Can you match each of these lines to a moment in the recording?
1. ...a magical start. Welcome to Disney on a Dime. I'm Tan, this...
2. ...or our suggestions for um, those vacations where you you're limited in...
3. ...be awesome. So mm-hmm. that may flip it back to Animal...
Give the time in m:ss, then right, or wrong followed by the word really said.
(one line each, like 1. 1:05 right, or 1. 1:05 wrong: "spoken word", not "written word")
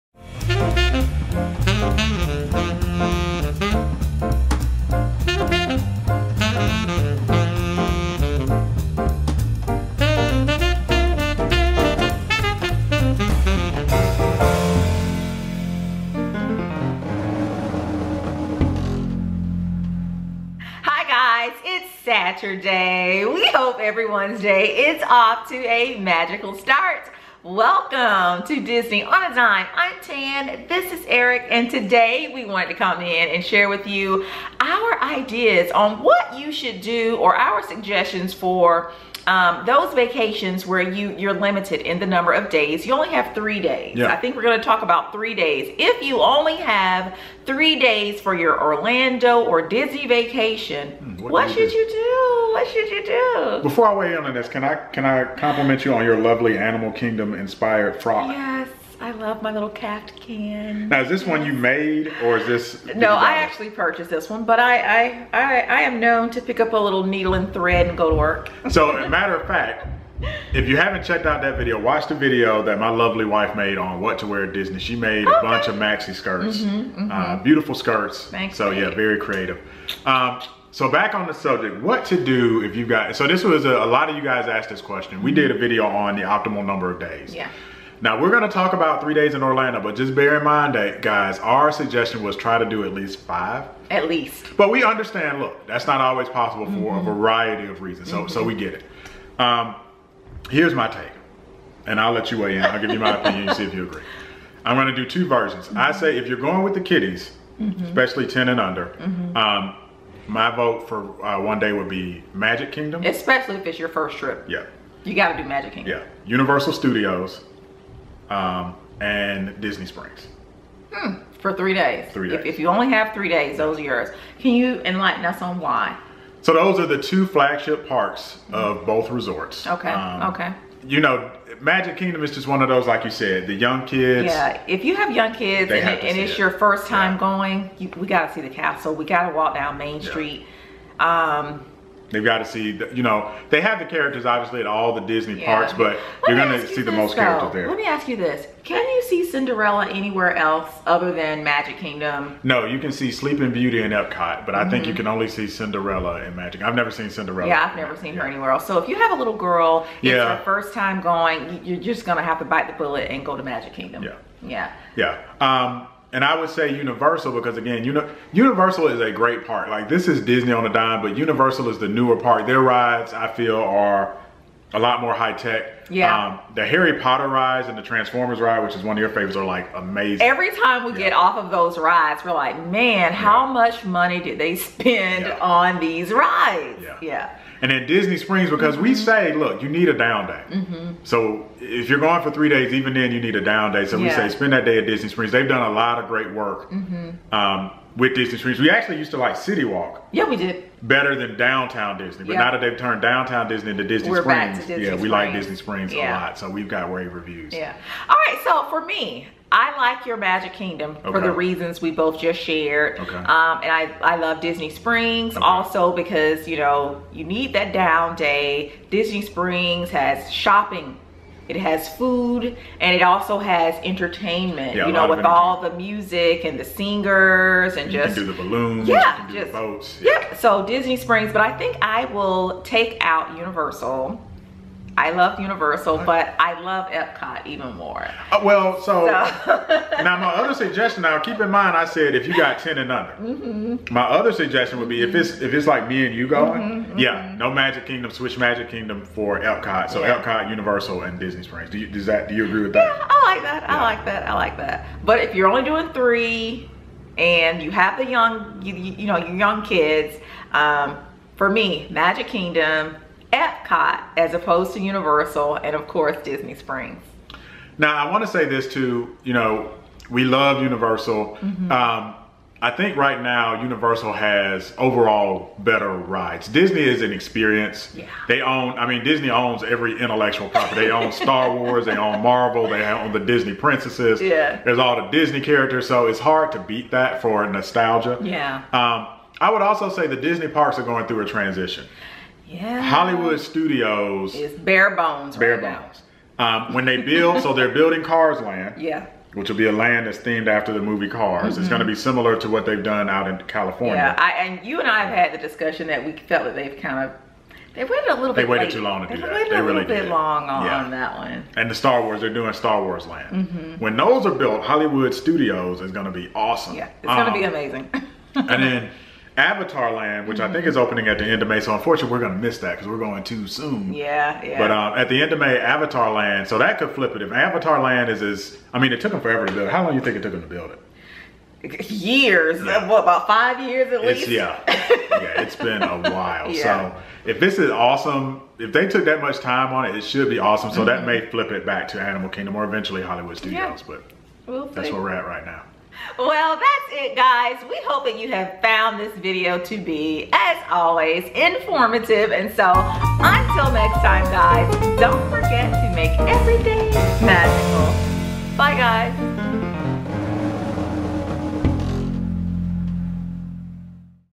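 1. 0:25 right
2. 0:37 right
3. 5:40 right.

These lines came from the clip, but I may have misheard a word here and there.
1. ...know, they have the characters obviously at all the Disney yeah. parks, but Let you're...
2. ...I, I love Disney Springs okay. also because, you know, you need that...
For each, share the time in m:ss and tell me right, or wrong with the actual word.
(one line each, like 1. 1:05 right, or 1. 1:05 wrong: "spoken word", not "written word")
1. 2:23 right
2. 3:33 right.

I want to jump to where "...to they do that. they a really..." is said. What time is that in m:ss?
5:09.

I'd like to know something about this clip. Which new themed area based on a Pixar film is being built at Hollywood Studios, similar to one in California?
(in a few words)
Cars Land.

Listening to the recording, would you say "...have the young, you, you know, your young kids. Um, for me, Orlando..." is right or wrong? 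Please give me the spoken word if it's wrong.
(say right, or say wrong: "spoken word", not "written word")
wrong: "Magic", not "Orlando".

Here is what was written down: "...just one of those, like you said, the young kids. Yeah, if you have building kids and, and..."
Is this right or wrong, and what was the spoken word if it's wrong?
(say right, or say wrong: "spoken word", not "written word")
wrong: "young", not "building".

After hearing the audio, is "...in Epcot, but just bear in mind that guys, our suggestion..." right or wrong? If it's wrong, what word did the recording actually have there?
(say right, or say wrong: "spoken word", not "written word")
wrong: "Orlando", not "Epcot".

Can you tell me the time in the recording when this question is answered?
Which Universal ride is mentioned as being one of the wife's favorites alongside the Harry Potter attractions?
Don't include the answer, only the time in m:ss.
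2:57.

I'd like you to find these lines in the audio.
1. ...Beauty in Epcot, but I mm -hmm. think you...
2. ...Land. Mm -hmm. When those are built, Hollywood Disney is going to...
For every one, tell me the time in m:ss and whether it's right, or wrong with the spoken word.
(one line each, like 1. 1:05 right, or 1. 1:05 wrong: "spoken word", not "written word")
1. 2:33 right
2. 5:13 wrong: "Studios", not "Disney".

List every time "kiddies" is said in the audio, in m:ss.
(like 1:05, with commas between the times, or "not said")
1:46.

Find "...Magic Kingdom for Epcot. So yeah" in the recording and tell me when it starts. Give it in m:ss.
4:08.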